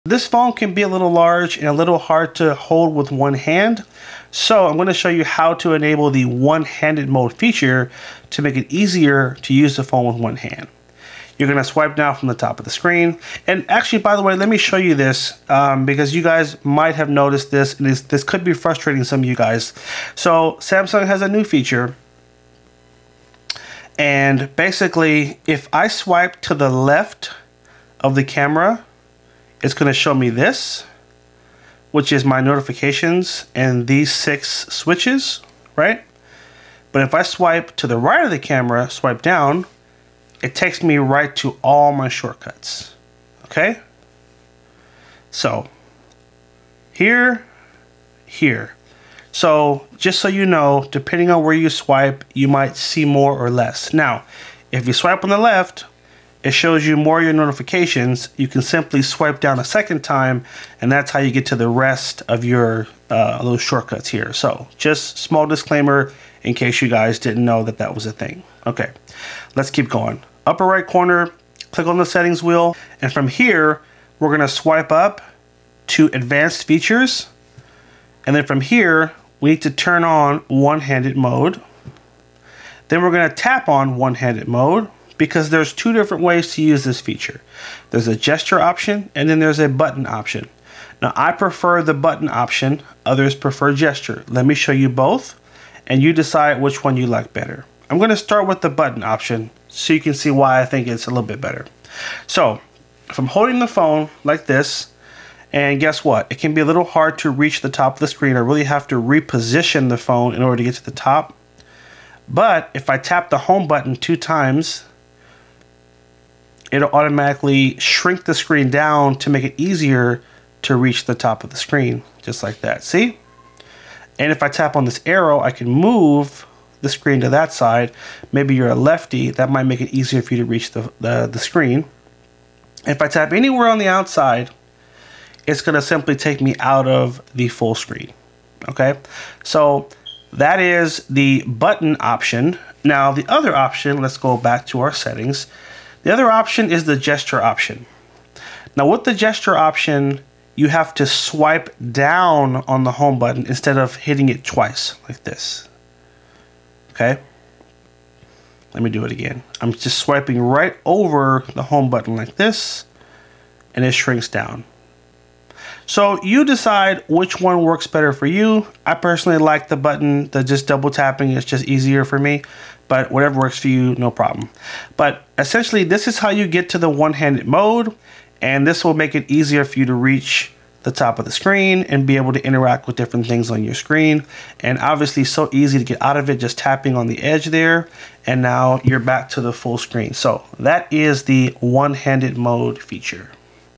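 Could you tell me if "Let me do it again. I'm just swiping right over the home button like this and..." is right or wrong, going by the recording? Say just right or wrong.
right.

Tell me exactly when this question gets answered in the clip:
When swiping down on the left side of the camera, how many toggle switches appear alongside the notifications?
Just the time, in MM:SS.
00:34.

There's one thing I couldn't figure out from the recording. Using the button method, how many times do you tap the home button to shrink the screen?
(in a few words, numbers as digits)
2.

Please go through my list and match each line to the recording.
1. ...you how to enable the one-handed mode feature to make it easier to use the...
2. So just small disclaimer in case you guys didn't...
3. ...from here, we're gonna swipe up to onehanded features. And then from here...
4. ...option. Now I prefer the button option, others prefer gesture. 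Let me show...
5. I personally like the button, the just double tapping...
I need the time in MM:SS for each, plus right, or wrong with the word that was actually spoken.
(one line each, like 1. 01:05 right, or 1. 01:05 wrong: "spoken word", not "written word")
1. 00:05 right
2. 01:04 right
3. 01:13 wrong: "advanced", not "onehanded"
4. 01:30 right
5. 02:48 right.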